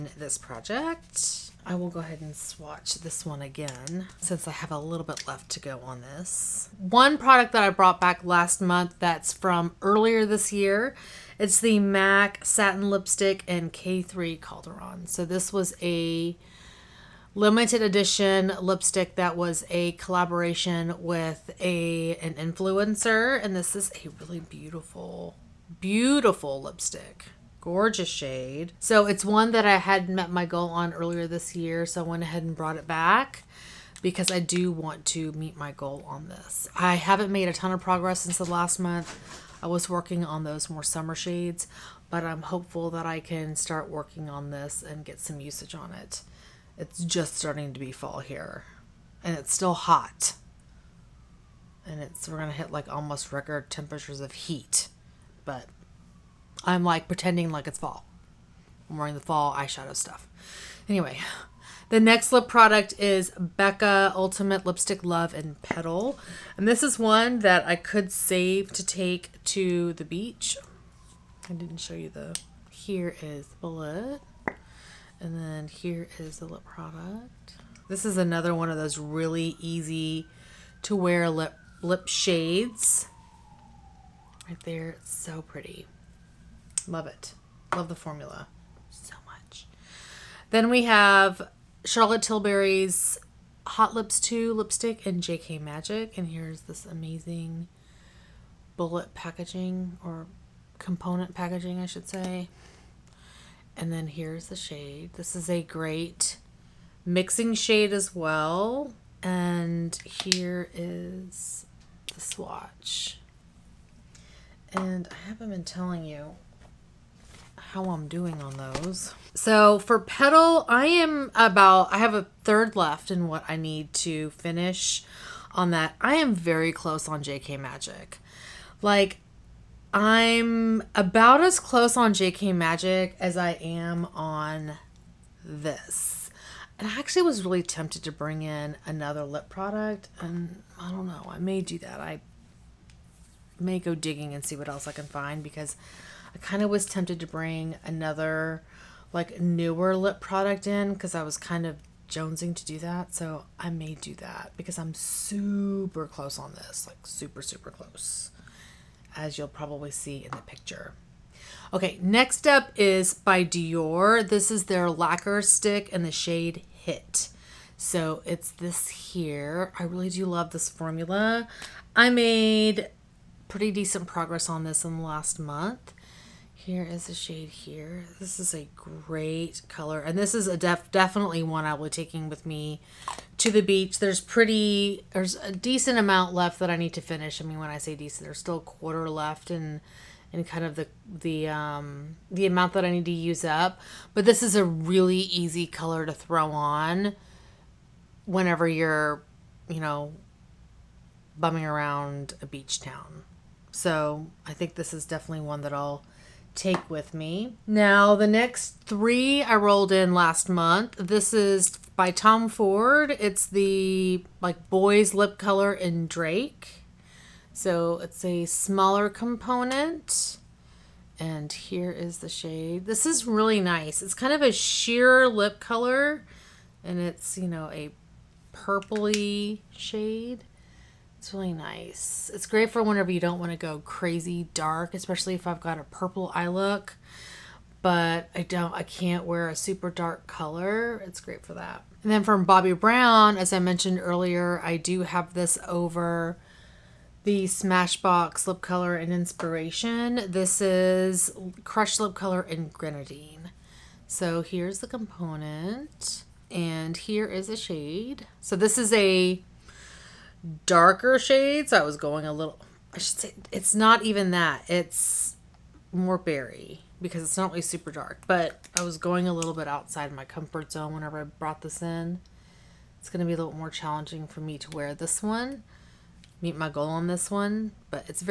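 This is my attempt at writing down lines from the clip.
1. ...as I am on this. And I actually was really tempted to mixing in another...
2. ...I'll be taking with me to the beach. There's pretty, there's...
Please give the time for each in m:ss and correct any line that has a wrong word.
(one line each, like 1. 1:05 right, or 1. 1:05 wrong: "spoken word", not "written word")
1. 2:13 wrong: "bring", not "mixing"
2. 3:01 right.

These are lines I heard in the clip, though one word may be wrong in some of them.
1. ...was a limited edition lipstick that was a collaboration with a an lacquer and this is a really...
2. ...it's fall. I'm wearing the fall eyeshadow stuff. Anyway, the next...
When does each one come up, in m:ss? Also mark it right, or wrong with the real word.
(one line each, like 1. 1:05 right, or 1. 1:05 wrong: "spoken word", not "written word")
1. 0:15 wrong: "influencer", not "lacquer"
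2. 0:57 right.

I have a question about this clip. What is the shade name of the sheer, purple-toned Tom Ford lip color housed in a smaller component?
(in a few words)
Drake.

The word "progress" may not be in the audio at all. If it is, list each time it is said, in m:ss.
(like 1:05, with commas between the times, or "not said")
0:37, 2:54.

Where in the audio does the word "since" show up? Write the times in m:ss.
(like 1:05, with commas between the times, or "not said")
0:04, 0:38.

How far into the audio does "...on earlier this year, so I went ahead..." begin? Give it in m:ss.
0:30.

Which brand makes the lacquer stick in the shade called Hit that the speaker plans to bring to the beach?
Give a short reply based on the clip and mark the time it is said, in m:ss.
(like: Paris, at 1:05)
Dior, at 2:43.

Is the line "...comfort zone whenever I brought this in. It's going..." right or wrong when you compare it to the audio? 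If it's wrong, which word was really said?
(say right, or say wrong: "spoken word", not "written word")
right.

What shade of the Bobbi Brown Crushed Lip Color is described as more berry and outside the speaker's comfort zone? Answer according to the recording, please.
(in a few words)
Grenadine.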